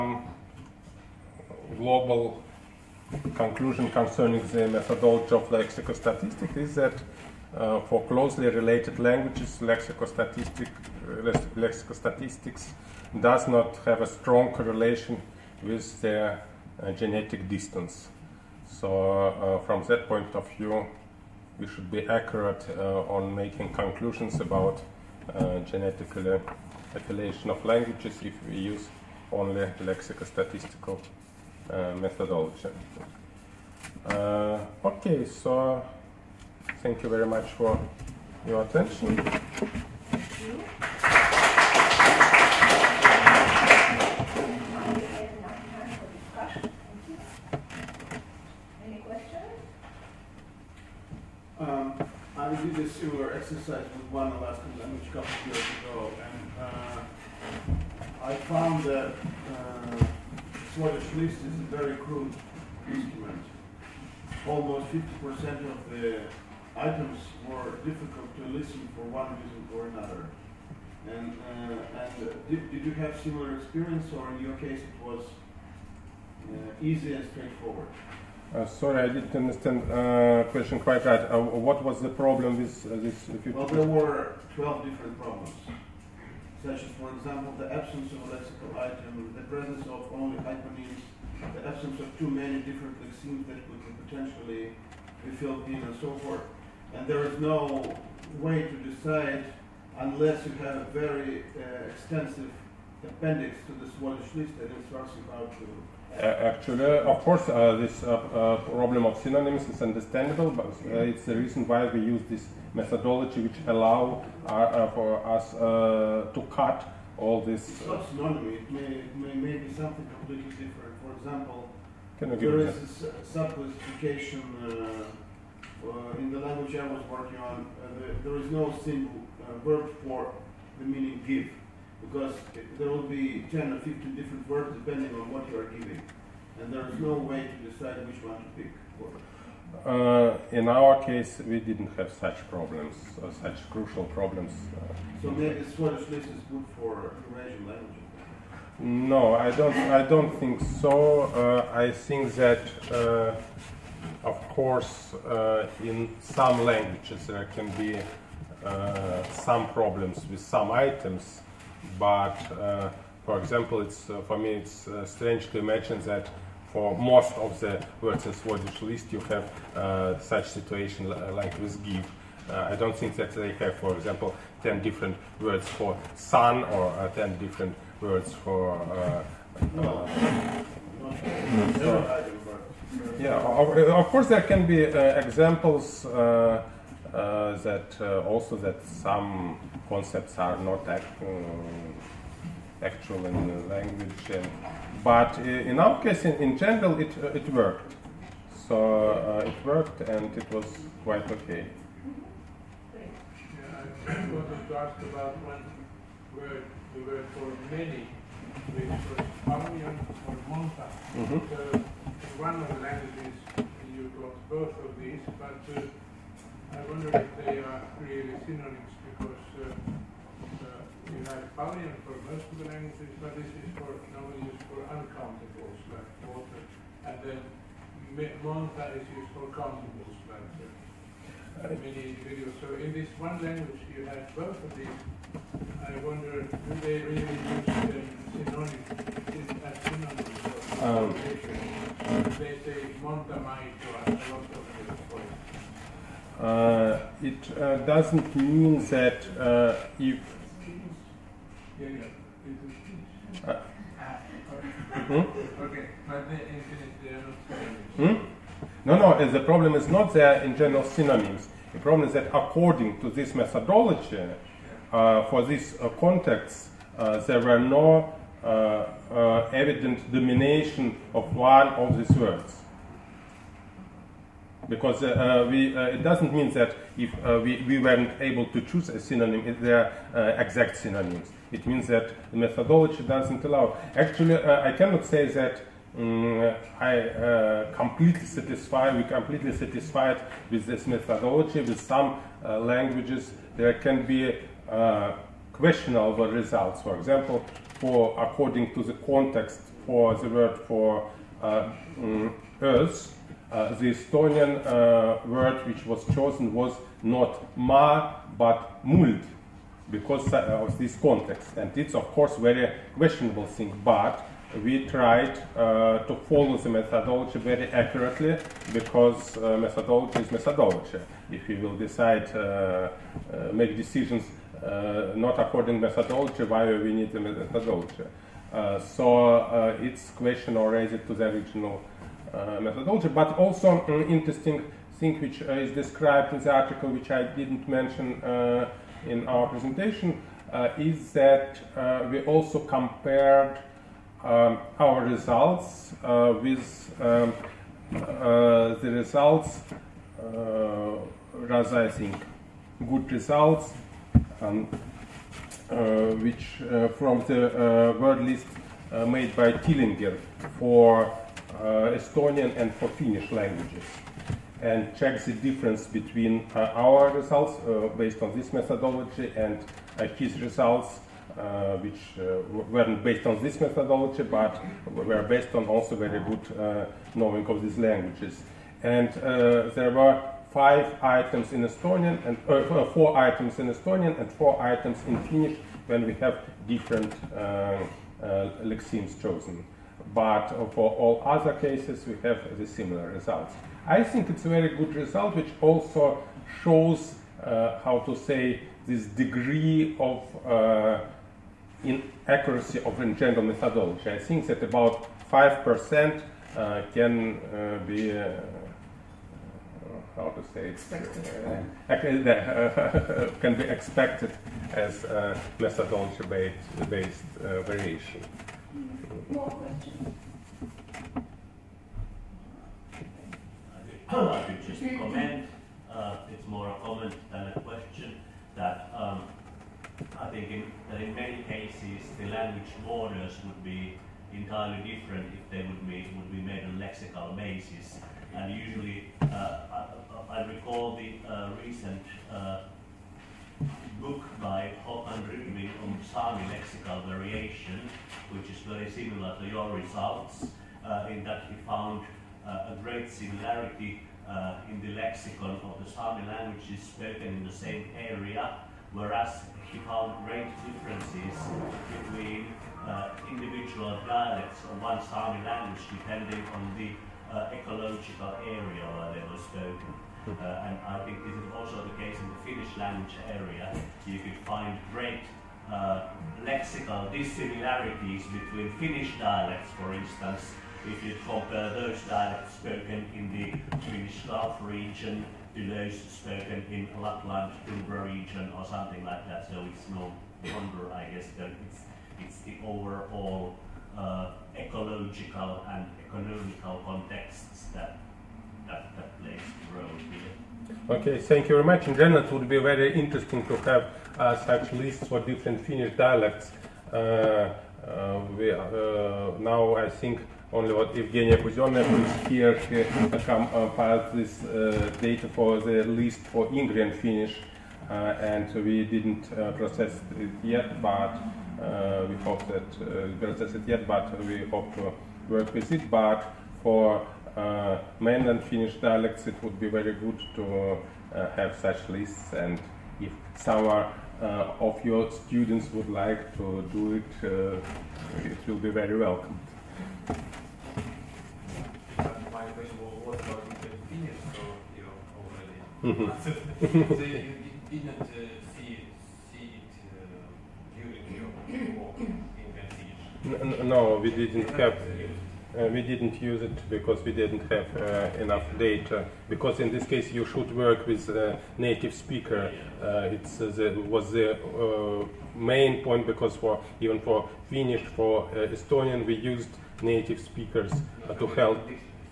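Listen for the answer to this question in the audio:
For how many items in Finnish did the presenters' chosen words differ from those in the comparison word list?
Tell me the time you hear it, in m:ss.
6:24.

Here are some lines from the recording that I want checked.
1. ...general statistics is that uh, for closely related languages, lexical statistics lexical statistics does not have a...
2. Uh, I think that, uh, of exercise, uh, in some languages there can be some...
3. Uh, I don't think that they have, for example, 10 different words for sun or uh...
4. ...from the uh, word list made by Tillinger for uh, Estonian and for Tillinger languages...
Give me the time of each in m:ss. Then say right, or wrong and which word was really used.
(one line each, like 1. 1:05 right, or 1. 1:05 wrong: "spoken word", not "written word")
1. 0:05 wrong: "lexical", not "general"
2. 2:31 wrong: "course", not "exercise"
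3. 2:52 right
4. 5:56 wrong: "Finnish", not "Tillinger".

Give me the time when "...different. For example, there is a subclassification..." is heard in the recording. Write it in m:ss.
2:00.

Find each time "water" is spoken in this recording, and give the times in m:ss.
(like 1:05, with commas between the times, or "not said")
3:46.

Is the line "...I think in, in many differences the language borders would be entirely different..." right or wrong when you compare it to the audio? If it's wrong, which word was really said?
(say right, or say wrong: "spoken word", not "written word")
wrong: "cases", not "differences".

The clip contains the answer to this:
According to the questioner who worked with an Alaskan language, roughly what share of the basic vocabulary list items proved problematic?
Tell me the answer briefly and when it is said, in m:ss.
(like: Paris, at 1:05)
50%, at 1:04.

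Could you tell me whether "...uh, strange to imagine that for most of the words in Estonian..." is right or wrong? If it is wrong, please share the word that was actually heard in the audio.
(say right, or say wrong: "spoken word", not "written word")
wrong: "Swadesh", not "Estonian".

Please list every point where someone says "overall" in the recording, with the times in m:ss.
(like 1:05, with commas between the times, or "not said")
8:12.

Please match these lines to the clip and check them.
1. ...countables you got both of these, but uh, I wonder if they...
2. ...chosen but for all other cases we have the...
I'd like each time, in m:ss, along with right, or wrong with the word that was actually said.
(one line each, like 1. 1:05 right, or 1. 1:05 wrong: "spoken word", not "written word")
1. 3:32 wrong: "languages", not "countables"
2. 6:29 right.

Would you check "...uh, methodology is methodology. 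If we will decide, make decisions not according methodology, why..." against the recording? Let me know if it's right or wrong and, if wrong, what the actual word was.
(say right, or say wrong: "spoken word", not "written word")
right.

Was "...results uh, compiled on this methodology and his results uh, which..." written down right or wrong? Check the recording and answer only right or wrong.
wrong.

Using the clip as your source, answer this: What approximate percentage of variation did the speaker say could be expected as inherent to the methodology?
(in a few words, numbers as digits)
5%.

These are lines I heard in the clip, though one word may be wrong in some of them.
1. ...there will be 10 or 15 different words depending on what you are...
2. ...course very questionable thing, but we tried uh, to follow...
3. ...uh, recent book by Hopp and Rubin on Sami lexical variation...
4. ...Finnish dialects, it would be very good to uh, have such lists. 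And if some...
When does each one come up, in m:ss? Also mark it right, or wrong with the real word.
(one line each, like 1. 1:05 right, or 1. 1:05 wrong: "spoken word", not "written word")
1. 2:12 right
2. 5:12 right
3. 7:21 right
4. 8:48 right.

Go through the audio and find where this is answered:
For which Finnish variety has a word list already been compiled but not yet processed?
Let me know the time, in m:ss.
8:36.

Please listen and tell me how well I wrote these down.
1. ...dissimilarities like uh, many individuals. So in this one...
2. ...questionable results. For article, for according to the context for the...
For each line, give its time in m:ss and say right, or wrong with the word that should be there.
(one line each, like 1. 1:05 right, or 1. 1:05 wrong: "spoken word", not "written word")
1. 3:49 wrong: "countables", not "dissimilarities"
2. 4:55 wrong: "example", not "article".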